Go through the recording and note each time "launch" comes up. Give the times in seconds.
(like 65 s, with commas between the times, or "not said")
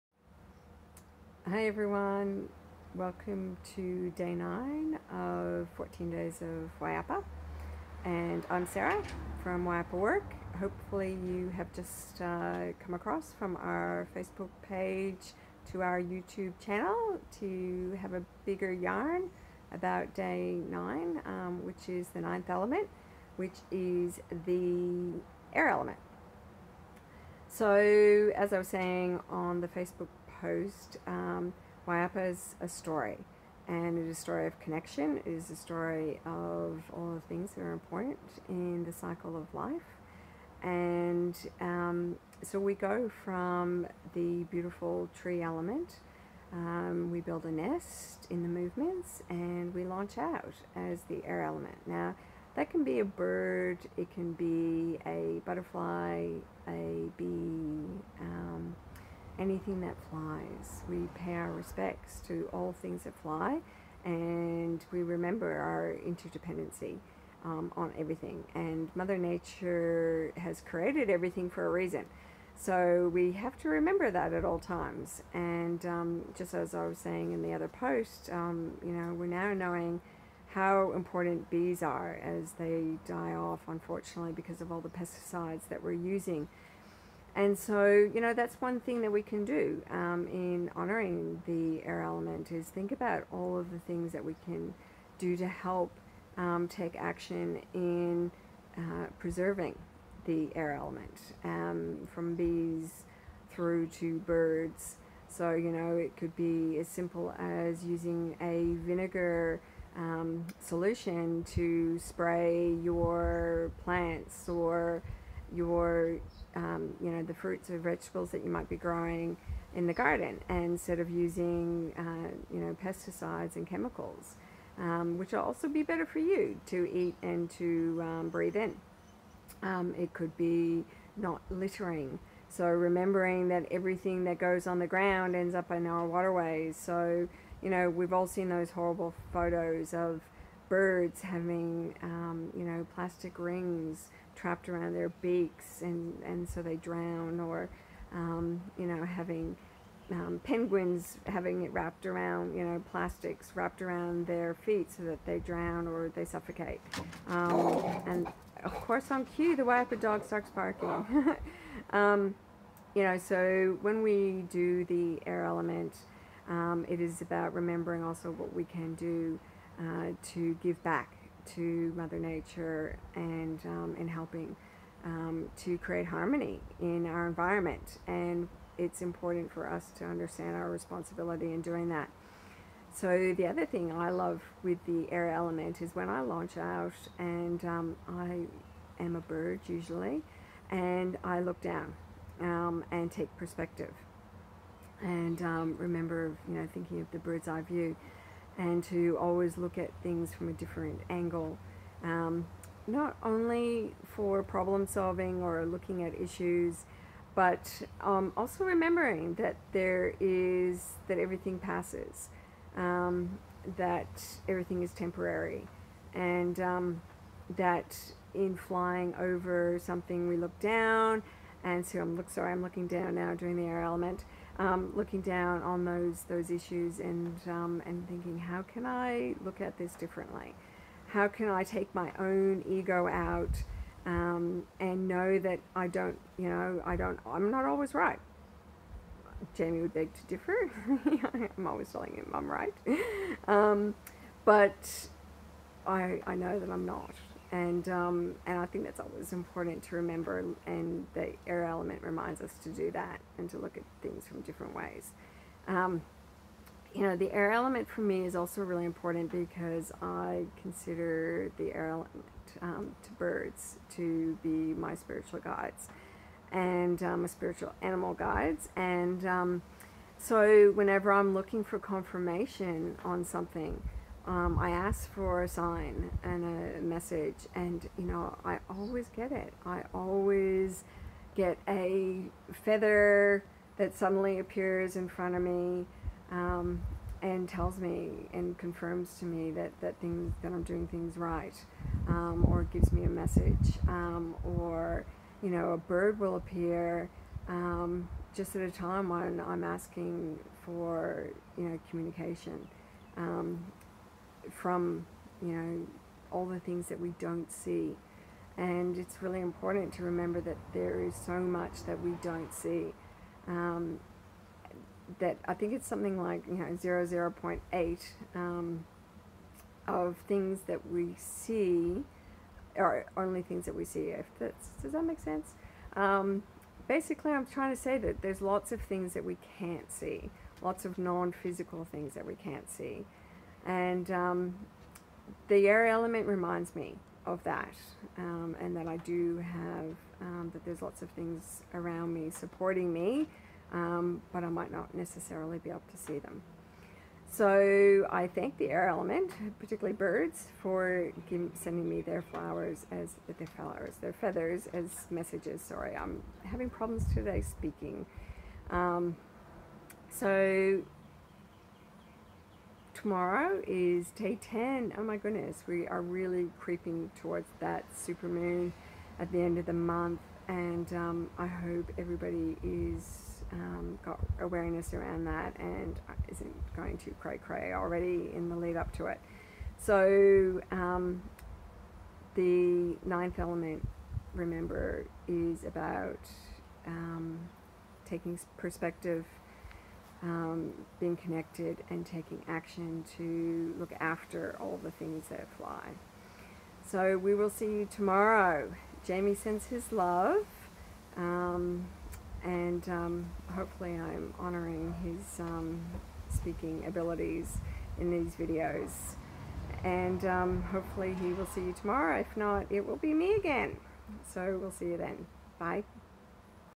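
49 s, 186 s.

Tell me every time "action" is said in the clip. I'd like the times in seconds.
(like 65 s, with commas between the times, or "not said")
96 s, 392 s.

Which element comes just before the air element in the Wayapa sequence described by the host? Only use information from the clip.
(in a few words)
Tree element.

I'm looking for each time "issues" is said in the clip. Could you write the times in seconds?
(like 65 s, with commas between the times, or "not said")
206 s, 226 s.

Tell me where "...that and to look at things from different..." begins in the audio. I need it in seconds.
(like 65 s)
252 s.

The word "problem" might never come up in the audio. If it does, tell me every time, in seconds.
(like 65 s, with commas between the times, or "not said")
204 s, 356 s.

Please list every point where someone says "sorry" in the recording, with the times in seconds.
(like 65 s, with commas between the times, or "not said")
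222 s, 355 s.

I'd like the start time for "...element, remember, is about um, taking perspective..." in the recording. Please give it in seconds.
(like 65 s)
383 s.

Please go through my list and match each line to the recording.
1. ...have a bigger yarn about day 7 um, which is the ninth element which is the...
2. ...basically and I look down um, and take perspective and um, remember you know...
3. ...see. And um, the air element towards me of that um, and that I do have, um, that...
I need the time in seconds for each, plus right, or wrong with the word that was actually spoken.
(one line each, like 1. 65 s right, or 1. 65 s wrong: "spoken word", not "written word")
1. 17 s wrong: "9", not "7"
2. 189 s wrong: "usually", not "basically"
3. 332 s wrong: "reminds", not "towards".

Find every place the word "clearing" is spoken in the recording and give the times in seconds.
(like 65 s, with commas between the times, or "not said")
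not said.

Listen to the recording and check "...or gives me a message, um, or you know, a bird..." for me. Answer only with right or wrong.
right.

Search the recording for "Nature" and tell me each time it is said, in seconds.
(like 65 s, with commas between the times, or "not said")
69 s, 172 s.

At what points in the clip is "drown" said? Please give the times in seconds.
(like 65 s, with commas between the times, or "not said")
146 s, 155 s.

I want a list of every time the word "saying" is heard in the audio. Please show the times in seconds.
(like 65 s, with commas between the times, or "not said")
28 s, 76 s.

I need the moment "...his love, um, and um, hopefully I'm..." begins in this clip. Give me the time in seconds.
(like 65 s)
399 s.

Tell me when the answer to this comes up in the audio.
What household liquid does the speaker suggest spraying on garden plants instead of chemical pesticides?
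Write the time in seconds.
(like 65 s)
108 s.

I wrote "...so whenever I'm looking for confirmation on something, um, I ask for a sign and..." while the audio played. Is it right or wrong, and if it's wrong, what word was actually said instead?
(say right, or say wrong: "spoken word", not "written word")
right.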